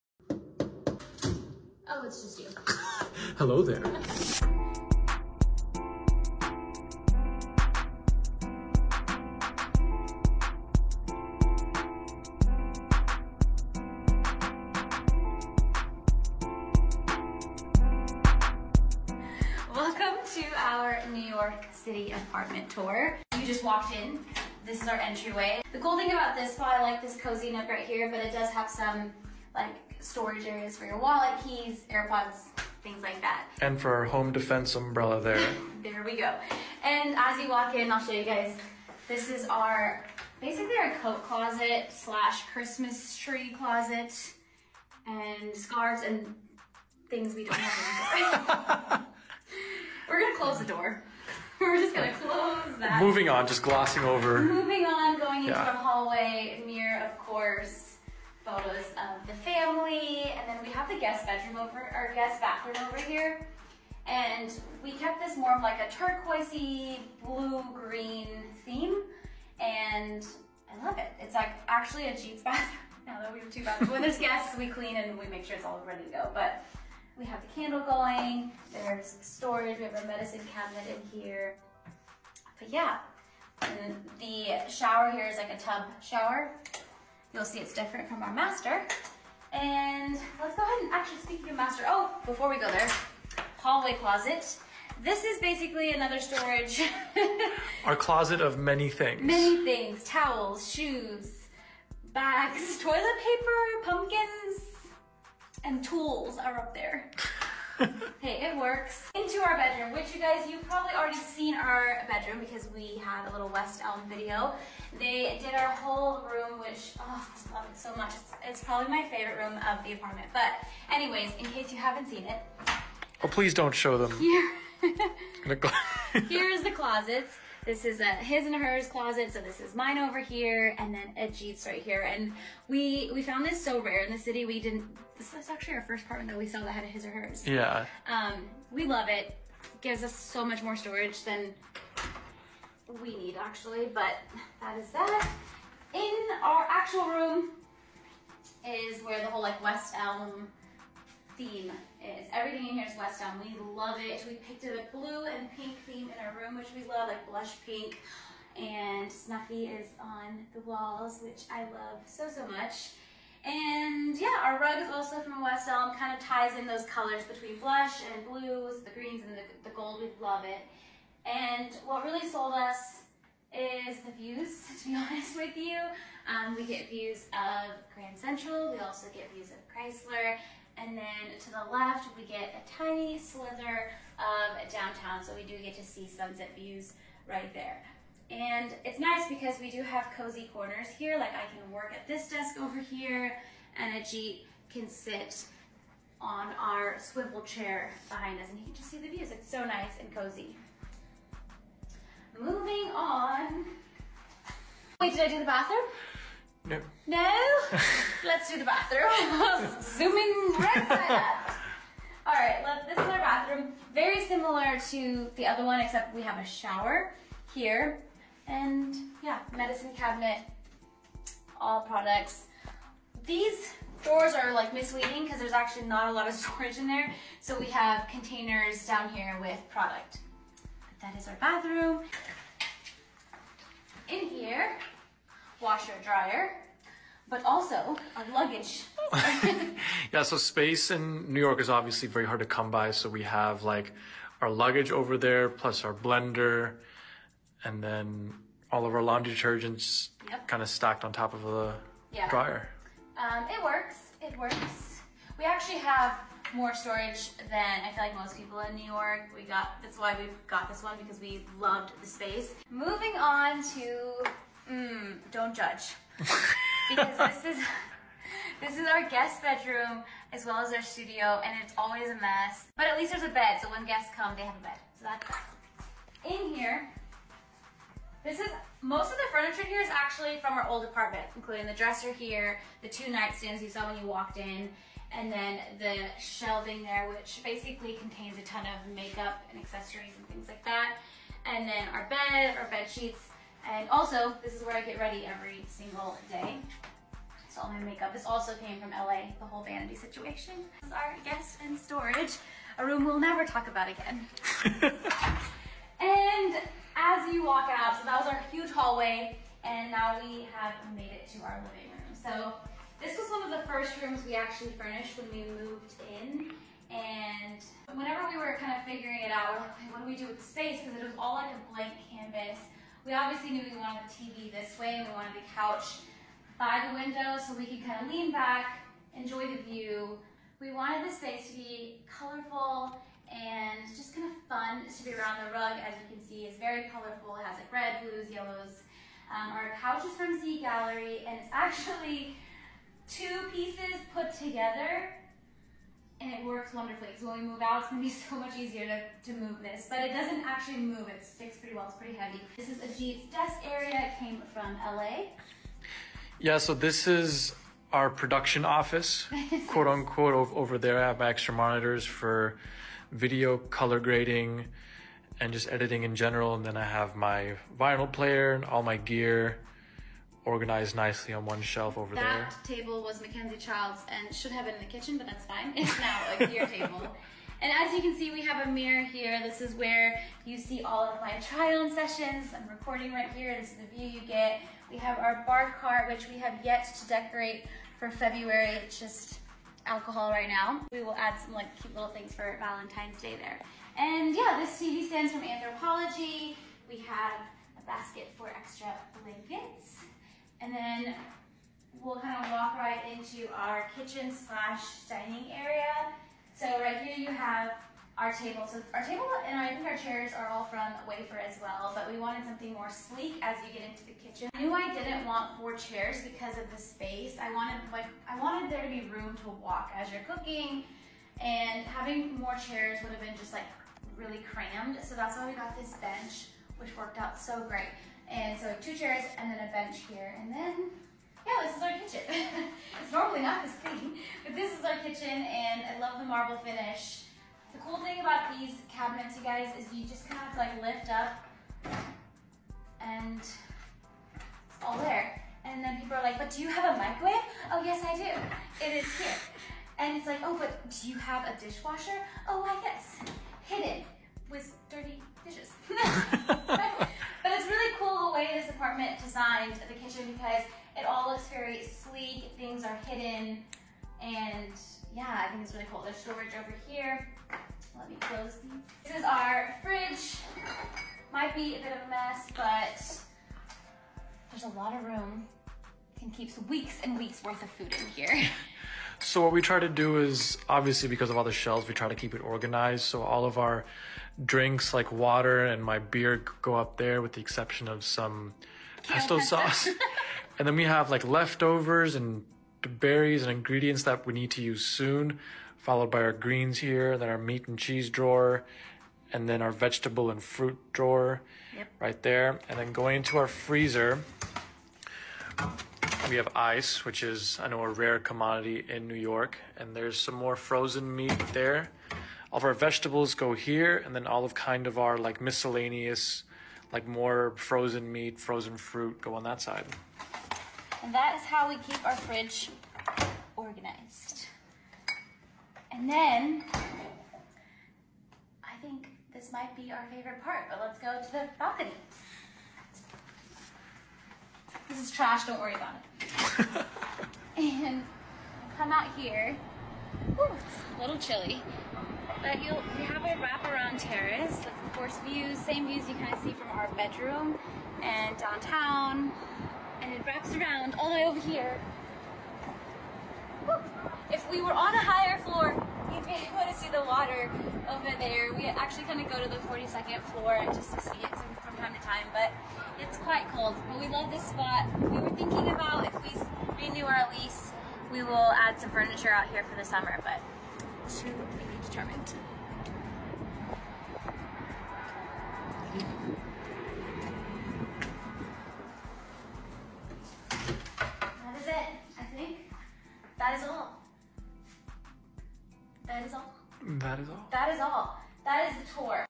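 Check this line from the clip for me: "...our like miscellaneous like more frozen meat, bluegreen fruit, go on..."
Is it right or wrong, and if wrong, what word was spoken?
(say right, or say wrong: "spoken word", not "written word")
wrong: "frozen", not "bluegreen".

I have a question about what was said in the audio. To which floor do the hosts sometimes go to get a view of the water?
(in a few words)
42nd floor.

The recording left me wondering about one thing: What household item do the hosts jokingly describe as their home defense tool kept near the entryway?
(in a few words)
Umbrella.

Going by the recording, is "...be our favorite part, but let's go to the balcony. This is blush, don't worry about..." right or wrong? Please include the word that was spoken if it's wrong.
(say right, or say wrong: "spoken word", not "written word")
wrong: "trash", not "blush".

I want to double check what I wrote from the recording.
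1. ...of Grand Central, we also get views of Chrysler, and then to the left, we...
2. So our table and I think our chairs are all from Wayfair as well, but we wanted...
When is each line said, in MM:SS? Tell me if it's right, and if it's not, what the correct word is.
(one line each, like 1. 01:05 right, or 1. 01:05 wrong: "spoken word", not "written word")
1. 02:57 right
2. 06:48 right.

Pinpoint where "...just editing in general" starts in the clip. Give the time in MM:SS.
06:05.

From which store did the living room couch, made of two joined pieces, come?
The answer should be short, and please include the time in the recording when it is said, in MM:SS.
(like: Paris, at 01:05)
Z Gallerie, at 05:40.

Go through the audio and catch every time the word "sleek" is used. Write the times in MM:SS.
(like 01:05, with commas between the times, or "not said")
06:52, 07:41.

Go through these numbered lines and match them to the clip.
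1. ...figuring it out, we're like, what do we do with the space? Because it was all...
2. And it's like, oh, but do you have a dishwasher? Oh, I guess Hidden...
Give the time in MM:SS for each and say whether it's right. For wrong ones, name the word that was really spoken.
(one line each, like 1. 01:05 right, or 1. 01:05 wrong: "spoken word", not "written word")
1. 05:18 right
2. 07:29 right.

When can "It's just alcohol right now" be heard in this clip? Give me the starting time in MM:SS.
06:28.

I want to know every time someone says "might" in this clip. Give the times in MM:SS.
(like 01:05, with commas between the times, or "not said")
07:51, 08:49.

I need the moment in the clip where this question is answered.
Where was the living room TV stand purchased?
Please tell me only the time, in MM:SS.
06:35.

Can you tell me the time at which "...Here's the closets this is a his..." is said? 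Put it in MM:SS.
02:06.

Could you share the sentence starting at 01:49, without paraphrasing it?
Into our bedroom, which you guys, you've probably already seen our bedroom because we had a little West Elm video.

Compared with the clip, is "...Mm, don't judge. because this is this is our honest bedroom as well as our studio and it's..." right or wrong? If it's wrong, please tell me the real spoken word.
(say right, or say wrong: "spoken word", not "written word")
wrong: "guest", not "honest".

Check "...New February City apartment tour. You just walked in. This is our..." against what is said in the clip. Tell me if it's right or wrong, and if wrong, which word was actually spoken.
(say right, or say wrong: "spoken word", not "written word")
wrong: "York", not "February".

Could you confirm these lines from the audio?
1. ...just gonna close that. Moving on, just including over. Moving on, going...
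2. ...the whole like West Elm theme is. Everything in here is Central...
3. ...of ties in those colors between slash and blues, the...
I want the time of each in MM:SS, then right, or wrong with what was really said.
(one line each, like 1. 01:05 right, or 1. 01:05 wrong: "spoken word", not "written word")
1. 00:51 wrong: "glossing", not "including"
2. 02:29 wrong: "West", not "Central"
3. 02:46 wrong: "blush", not "slash".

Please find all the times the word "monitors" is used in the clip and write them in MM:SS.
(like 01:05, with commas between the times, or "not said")
06:01.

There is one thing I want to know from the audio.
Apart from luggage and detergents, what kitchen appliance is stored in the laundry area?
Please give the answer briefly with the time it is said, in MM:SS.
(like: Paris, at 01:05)
Blender, at 04:05.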